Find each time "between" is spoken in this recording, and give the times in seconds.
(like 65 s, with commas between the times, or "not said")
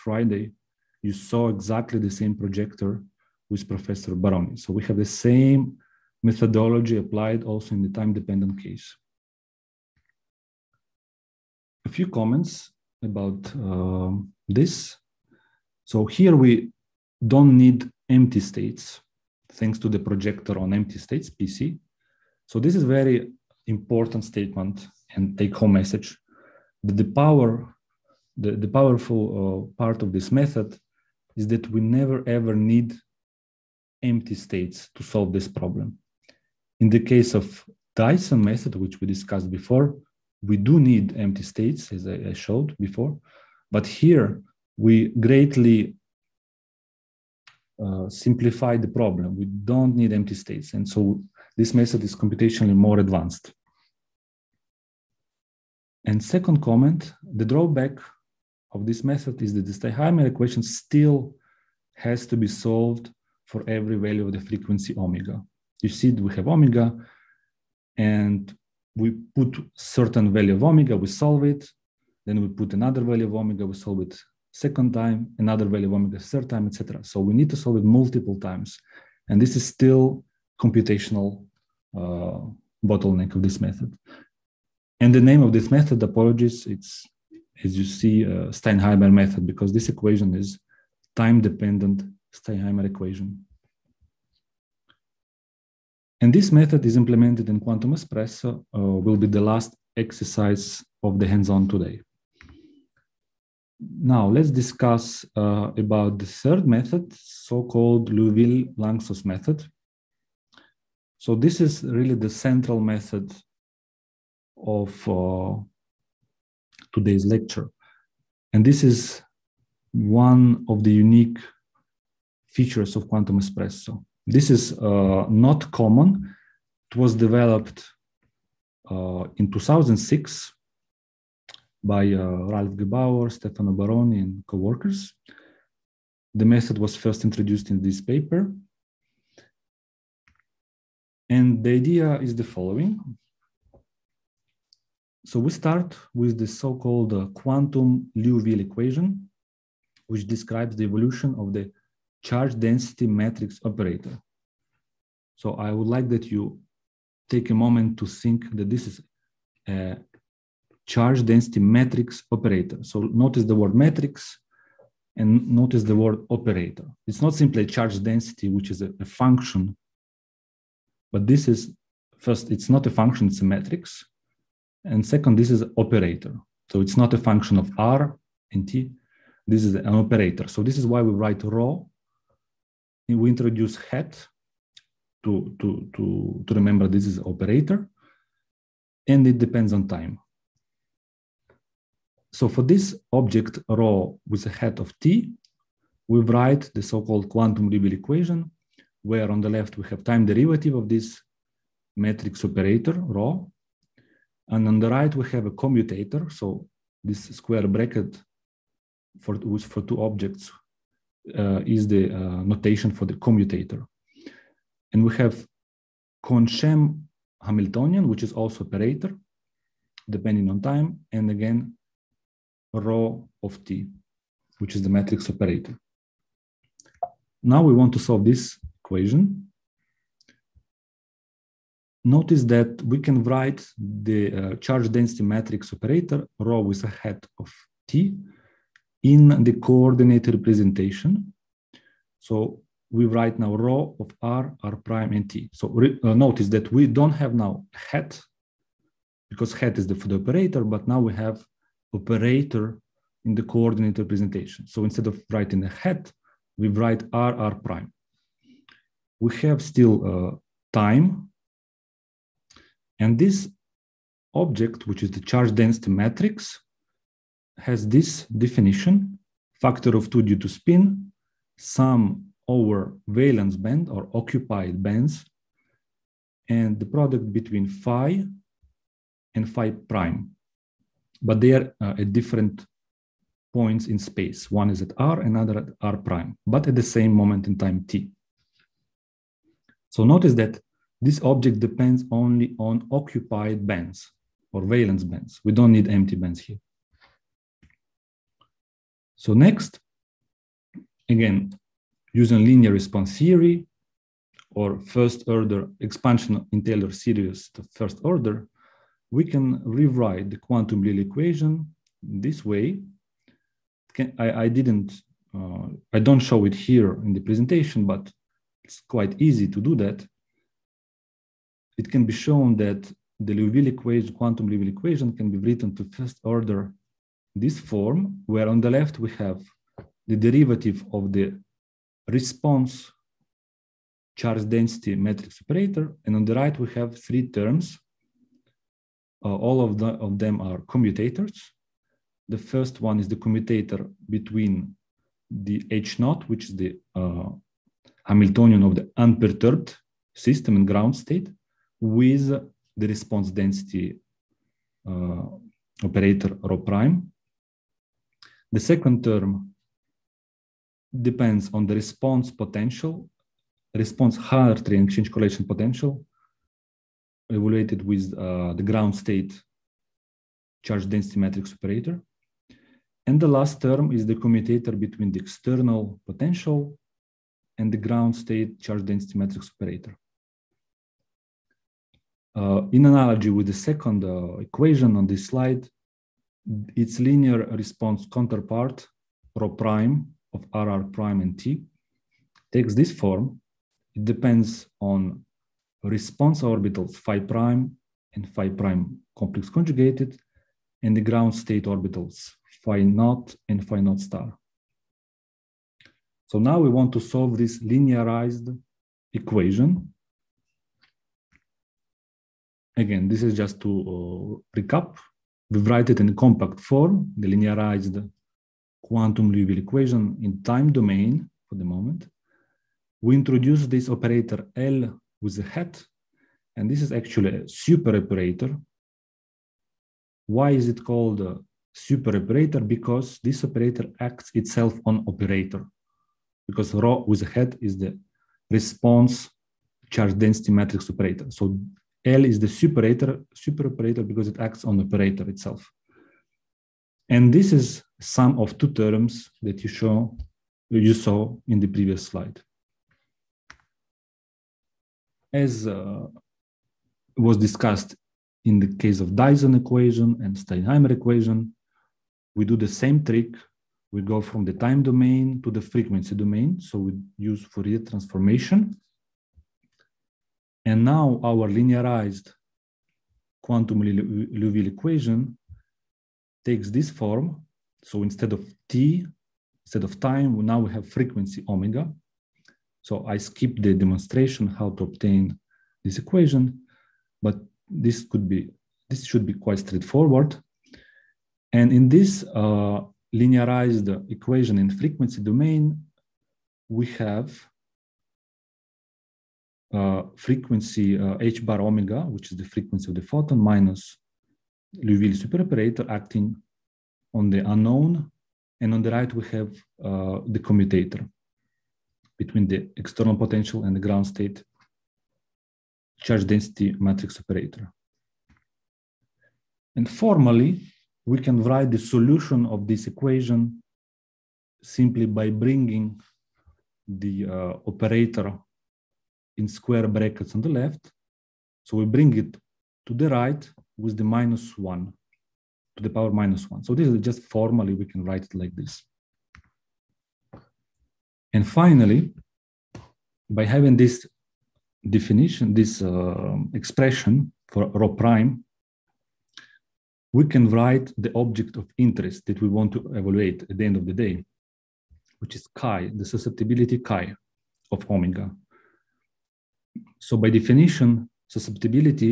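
277 s, 344 s, 374 s, 512 s.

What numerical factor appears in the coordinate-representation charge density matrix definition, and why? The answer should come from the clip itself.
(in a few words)
2, due to spin.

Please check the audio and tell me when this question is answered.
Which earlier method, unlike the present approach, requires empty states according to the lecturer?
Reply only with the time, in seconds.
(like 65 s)
37 s.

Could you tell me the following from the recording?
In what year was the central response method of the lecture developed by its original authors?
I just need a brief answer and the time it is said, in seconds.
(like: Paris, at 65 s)
2006, at 129 s.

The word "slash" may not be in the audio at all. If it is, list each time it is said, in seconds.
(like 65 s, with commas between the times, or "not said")
not said.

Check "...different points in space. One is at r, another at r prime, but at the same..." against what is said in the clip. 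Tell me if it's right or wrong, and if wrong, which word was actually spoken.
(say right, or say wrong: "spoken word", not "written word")
right.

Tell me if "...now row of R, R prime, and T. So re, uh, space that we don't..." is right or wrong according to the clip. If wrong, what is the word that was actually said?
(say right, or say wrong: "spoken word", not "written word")
wrong: "notice", not "space".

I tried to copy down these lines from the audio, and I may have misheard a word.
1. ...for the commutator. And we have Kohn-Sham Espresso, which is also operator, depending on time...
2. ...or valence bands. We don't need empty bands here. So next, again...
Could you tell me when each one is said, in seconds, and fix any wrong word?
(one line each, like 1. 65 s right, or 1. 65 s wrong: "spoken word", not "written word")
1. 212 s wrong: "Hamiltonian", not "Espresso"
2. 294 s right.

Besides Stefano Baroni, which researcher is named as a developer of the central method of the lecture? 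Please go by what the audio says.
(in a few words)
Ralph Gebauer.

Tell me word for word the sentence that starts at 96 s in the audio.
And this method is implemented in Quantum Espresso, uh, will be the last exercise of the hands-on today.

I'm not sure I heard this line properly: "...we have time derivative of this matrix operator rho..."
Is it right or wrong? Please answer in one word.
right.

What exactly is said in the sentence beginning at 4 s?
So we have the same methodology applied also in the time-dependent case.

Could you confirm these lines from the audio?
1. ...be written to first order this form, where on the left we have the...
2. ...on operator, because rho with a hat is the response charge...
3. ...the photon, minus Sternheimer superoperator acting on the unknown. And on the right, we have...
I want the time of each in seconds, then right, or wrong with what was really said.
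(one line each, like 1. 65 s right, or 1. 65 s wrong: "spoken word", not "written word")
1. 325 s right
2. 434 s right
3. 502 s wrong: "Liouville", not "Sternheimer".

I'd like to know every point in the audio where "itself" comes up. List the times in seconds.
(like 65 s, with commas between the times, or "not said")
434 s, 445 s.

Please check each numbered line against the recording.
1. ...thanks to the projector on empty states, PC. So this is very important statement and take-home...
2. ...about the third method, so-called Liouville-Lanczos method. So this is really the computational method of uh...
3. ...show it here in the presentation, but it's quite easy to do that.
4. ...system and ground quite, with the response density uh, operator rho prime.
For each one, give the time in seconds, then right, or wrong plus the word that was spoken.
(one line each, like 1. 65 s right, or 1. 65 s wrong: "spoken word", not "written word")
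1. 19 s right
2. 105 s wrong: "central", not "computational"
3. 316 s right
4. 350 s wrong: "state", not "quite".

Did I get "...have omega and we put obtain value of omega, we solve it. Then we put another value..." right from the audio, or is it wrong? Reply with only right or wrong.
wrong.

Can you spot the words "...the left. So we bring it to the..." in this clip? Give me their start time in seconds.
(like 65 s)
530 s.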